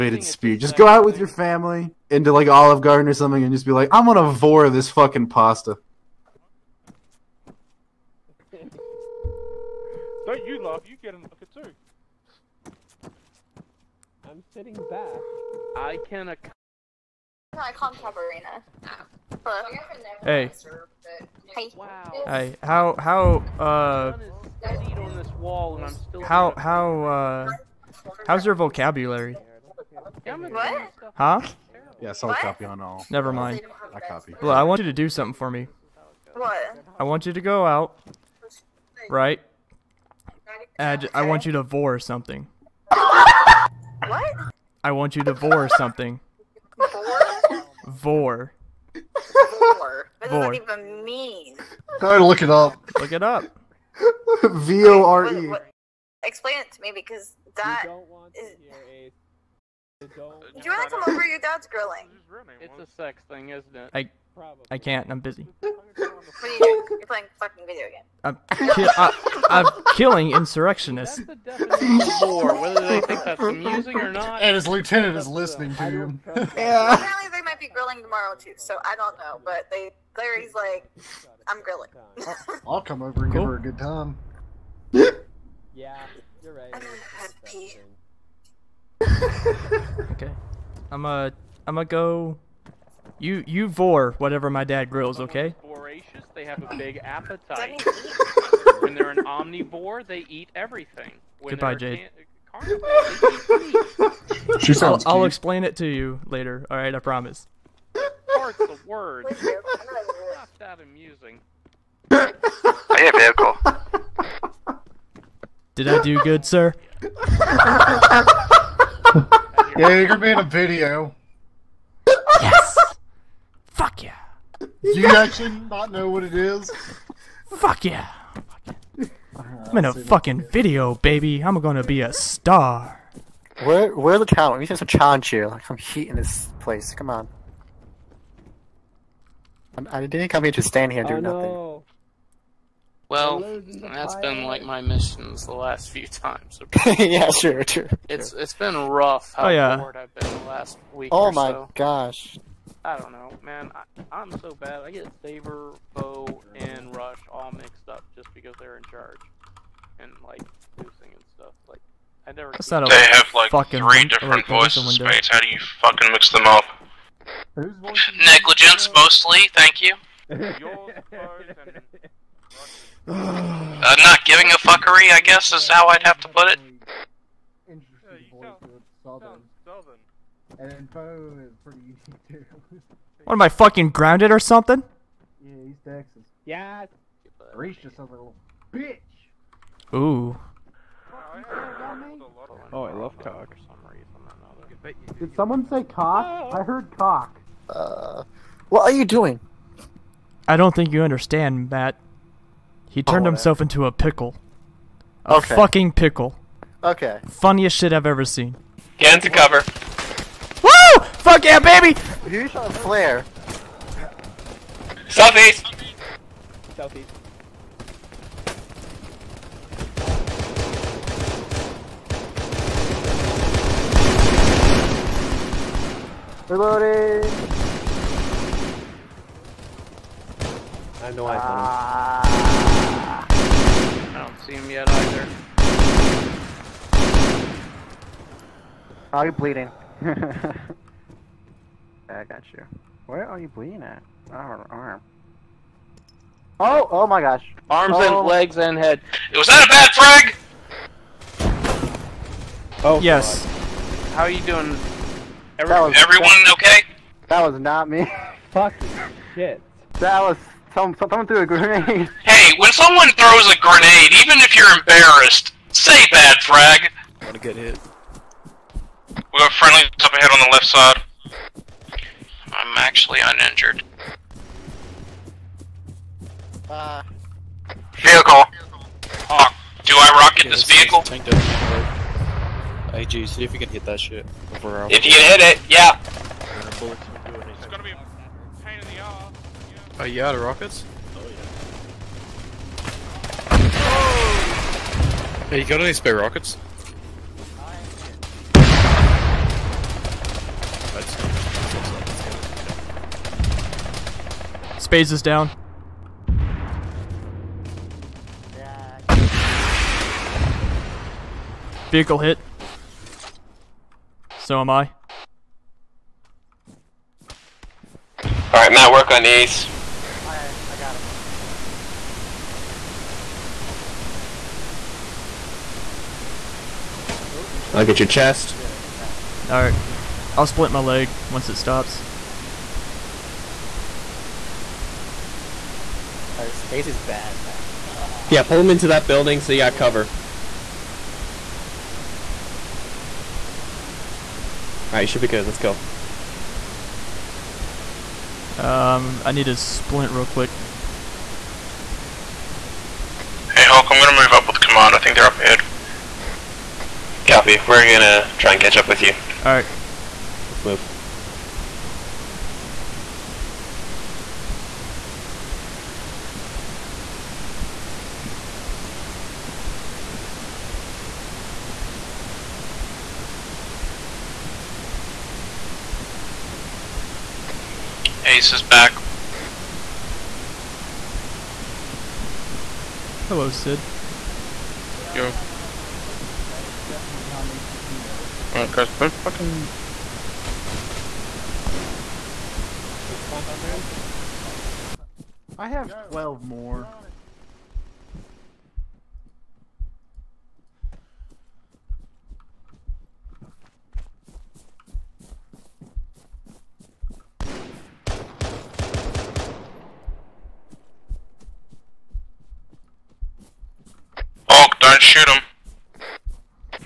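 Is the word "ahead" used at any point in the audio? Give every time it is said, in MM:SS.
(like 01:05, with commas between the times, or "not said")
04:30, 05:55.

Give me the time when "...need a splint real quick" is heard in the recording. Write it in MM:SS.
05:49.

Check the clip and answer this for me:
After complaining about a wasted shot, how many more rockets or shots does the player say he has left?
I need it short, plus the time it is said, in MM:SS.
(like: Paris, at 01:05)
12, at 06:36.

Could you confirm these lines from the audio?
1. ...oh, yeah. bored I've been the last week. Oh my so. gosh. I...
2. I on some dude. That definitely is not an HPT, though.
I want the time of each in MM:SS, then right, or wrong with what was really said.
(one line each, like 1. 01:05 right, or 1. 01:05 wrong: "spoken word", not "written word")
1. 02:29 right
2. 06:25 right.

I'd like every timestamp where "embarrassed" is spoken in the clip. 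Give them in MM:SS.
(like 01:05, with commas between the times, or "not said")
04:24.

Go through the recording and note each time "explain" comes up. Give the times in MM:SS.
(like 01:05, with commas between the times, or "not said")
00:56, 01:45.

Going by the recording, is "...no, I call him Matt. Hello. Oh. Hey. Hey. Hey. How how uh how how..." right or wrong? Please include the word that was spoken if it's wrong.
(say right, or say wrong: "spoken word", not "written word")
wrong: "Cabarina", not "Matt".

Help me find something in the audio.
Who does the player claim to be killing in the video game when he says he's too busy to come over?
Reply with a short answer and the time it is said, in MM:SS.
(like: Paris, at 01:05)
Insurrectionists, at 01:10.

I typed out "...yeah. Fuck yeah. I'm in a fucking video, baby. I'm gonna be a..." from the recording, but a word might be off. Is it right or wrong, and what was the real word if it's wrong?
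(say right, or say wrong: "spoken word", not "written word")
right.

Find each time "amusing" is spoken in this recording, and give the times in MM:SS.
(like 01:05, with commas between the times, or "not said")
01:13, 01:50.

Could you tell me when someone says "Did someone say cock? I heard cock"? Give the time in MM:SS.
03:15.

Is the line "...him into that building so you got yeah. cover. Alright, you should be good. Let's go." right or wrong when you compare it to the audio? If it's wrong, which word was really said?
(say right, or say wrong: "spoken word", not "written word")
right.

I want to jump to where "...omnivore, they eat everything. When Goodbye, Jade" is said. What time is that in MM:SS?
01:39.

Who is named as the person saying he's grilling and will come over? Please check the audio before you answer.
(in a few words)
Larry.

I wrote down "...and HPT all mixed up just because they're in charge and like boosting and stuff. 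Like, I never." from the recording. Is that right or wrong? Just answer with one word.
wrong.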